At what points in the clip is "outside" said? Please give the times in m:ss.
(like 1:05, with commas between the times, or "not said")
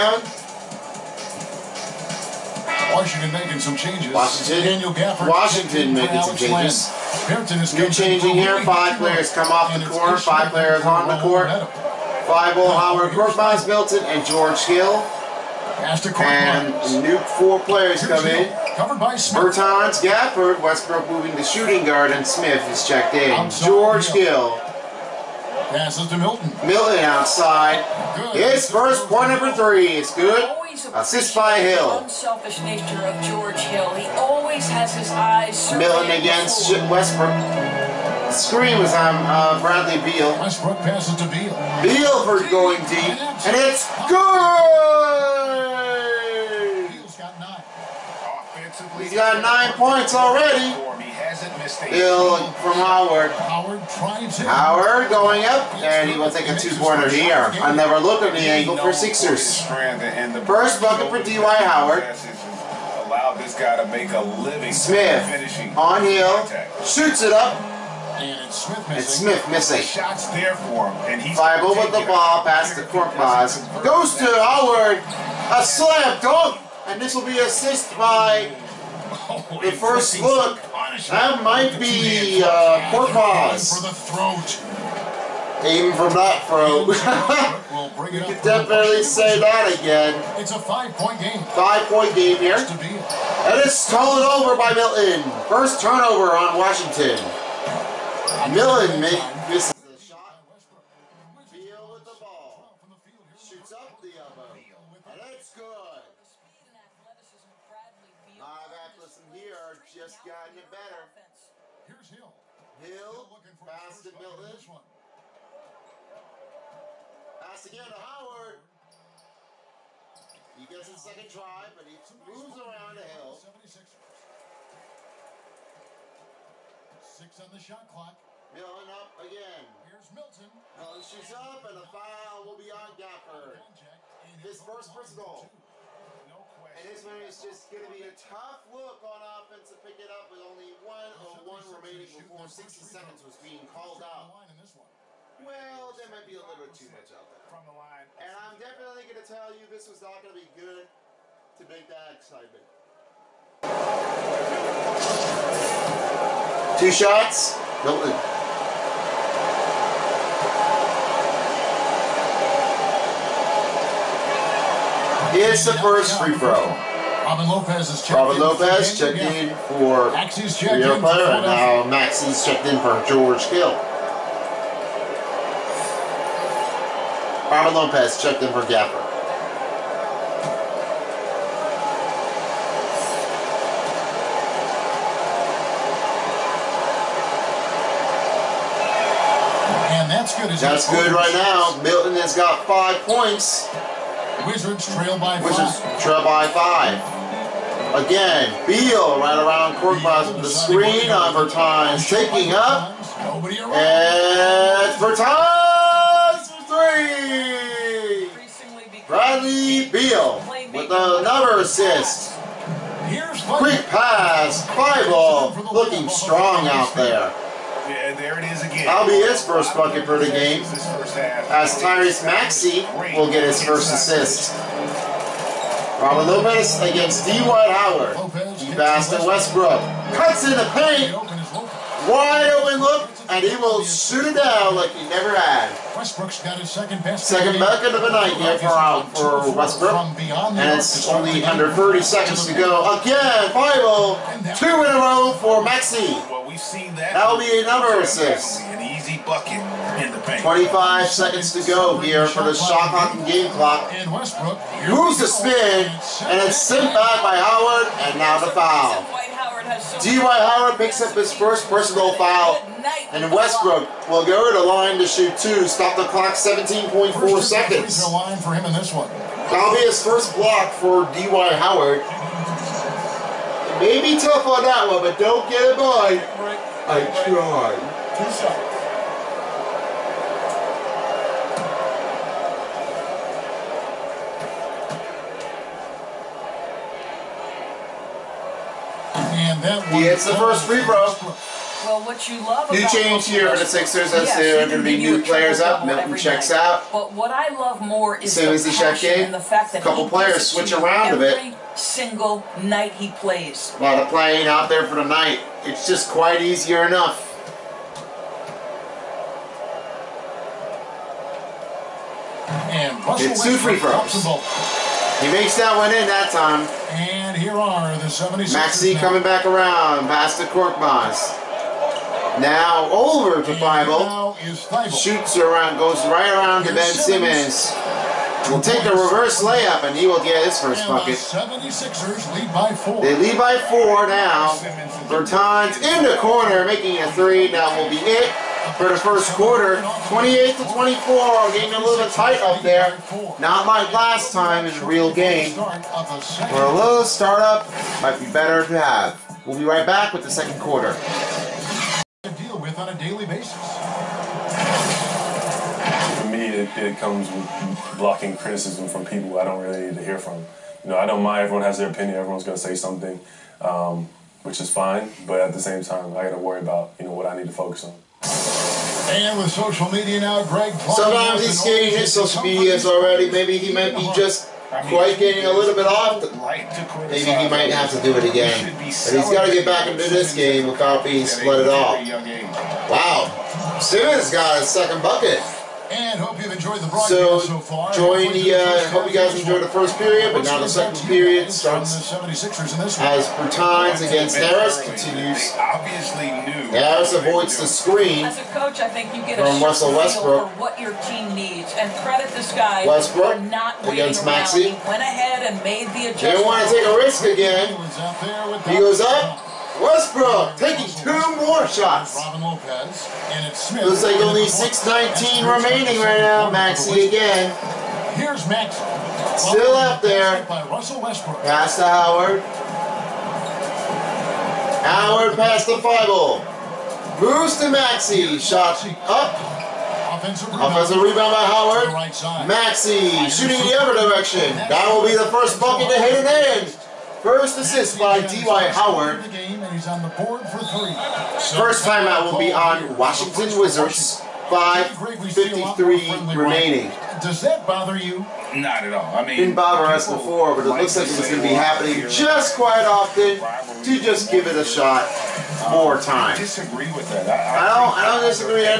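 0:26.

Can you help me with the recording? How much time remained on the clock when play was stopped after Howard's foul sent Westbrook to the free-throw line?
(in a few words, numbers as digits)
17.4 seconds.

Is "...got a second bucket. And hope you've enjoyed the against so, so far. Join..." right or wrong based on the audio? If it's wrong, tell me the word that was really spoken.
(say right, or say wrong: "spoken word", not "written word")
wrong: "broadcast", not "against".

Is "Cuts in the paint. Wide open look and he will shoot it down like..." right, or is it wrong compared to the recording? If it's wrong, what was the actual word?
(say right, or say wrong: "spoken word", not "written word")
right.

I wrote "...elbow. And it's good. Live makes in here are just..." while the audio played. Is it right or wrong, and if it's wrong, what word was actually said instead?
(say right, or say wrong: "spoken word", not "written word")
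wrong: "athletes", not "makes".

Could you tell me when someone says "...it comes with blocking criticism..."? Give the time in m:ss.
5:56.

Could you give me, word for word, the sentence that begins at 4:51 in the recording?
Well, what you love New change here for the Sixers.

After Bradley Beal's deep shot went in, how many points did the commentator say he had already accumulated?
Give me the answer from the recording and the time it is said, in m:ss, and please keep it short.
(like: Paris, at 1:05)
9, at 0:49.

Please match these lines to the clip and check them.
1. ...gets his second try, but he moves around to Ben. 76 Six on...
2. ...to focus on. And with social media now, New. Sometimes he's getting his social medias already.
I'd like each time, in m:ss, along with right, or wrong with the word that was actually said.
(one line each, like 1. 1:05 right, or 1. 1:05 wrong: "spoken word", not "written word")
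1. 2:00 wrong: "Hill", not "Ben"
2. 6:07 wrong: "Greg", not "New".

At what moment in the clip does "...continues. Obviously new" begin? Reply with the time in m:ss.
6:34.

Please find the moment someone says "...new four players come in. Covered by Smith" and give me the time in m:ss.
0:17.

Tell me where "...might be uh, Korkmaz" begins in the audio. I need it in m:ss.
1:21.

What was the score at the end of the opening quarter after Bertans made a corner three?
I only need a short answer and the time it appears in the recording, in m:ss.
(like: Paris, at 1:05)
28 to 24, at 5:40.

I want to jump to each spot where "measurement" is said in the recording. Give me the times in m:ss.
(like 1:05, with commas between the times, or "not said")
not said.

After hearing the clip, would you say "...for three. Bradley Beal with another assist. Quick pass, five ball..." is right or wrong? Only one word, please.
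right.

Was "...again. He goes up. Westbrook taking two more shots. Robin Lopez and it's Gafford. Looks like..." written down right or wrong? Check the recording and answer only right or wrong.
wrong.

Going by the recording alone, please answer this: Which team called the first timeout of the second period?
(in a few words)
Washington Wizards.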